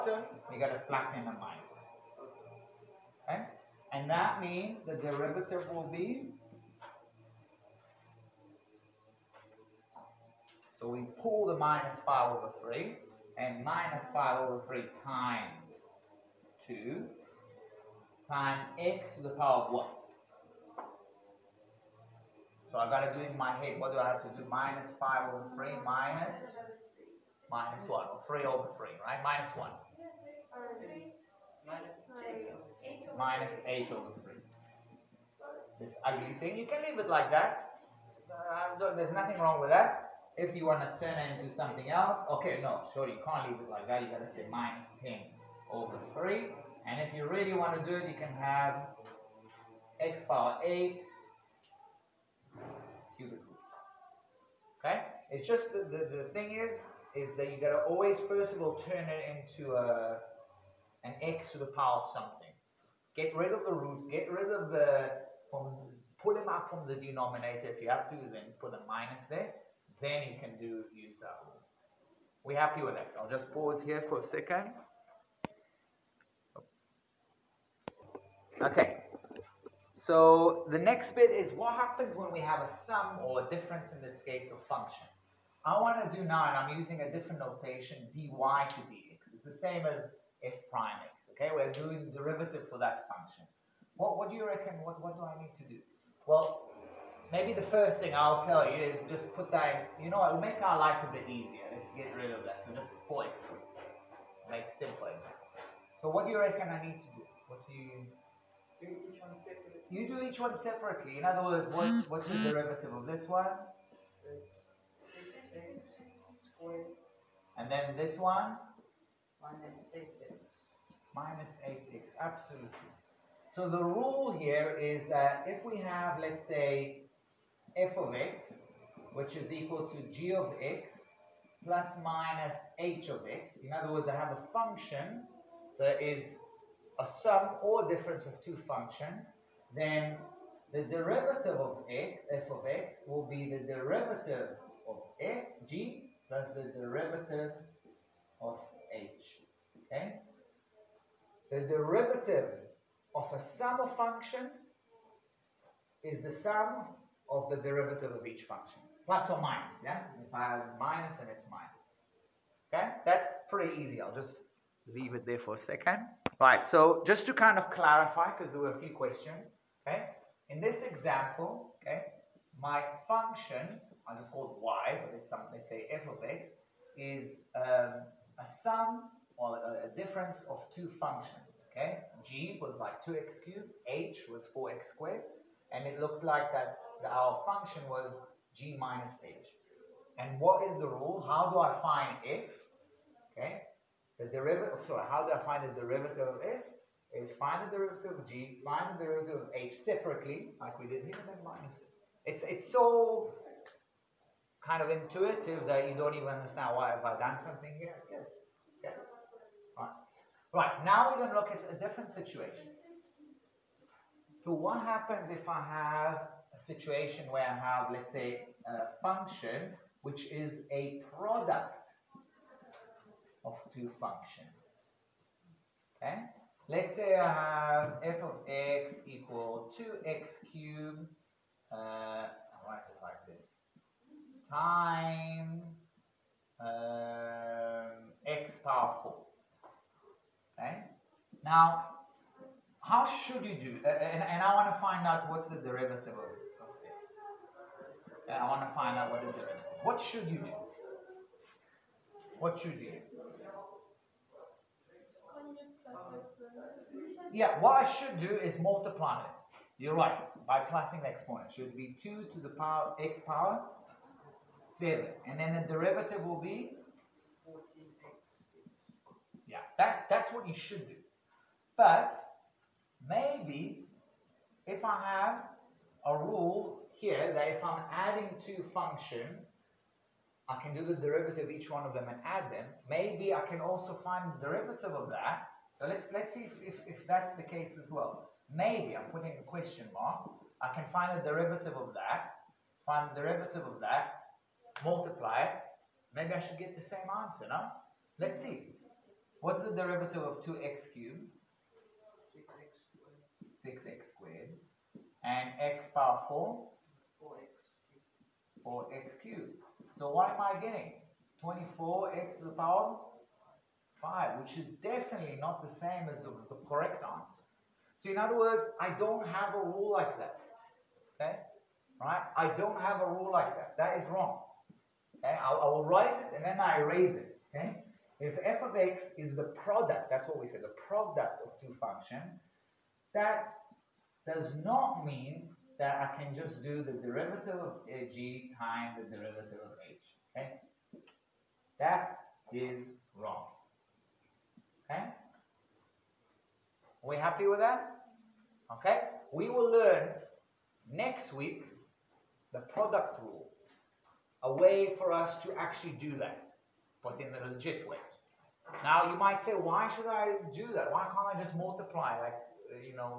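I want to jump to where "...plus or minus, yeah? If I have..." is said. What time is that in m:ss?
2:39.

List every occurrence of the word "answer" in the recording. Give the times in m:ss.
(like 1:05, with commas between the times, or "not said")
4:57, 5:17.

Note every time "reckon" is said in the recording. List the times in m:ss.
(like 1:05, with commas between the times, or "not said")
1:34, 1:46.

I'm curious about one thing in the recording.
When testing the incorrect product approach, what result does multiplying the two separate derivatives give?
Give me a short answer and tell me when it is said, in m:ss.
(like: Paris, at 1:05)
24x^5, at 5:11.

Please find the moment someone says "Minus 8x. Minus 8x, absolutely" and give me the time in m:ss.
1:59.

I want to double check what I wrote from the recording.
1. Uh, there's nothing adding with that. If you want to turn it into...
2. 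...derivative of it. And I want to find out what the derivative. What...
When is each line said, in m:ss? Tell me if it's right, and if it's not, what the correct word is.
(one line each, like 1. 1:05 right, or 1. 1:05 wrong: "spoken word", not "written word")
1. 0:38 wrong: "wrong", not "adding"
2. 4:05 right.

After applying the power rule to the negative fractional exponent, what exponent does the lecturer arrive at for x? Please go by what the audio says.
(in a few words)
-8/3.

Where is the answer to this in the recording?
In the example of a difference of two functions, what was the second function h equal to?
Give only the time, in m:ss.
3:04.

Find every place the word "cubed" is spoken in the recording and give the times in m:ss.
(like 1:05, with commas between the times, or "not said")
3:03, 3:50, 5:00, 5:09.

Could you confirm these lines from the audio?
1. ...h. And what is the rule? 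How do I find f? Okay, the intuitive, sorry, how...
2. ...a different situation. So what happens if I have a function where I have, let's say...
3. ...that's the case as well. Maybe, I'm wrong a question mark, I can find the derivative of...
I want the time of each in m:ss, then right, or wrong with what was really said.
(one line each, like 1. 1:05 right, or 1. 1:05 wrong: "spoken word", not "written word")
1. 3:09 wrong: "derivative", not "intuitive"
2. 3:31 wrong: "situation", not "function"
3. 4:47 wrong: "putting", not "wrong".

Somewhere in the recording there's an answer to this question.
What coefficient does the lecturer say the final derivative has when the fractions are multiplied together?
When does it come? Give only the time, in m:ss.
0:44.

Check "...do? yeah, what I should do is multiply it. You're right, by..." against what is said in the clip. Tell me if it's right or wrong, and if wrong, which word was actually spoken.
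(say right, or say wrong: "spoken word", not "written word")
right.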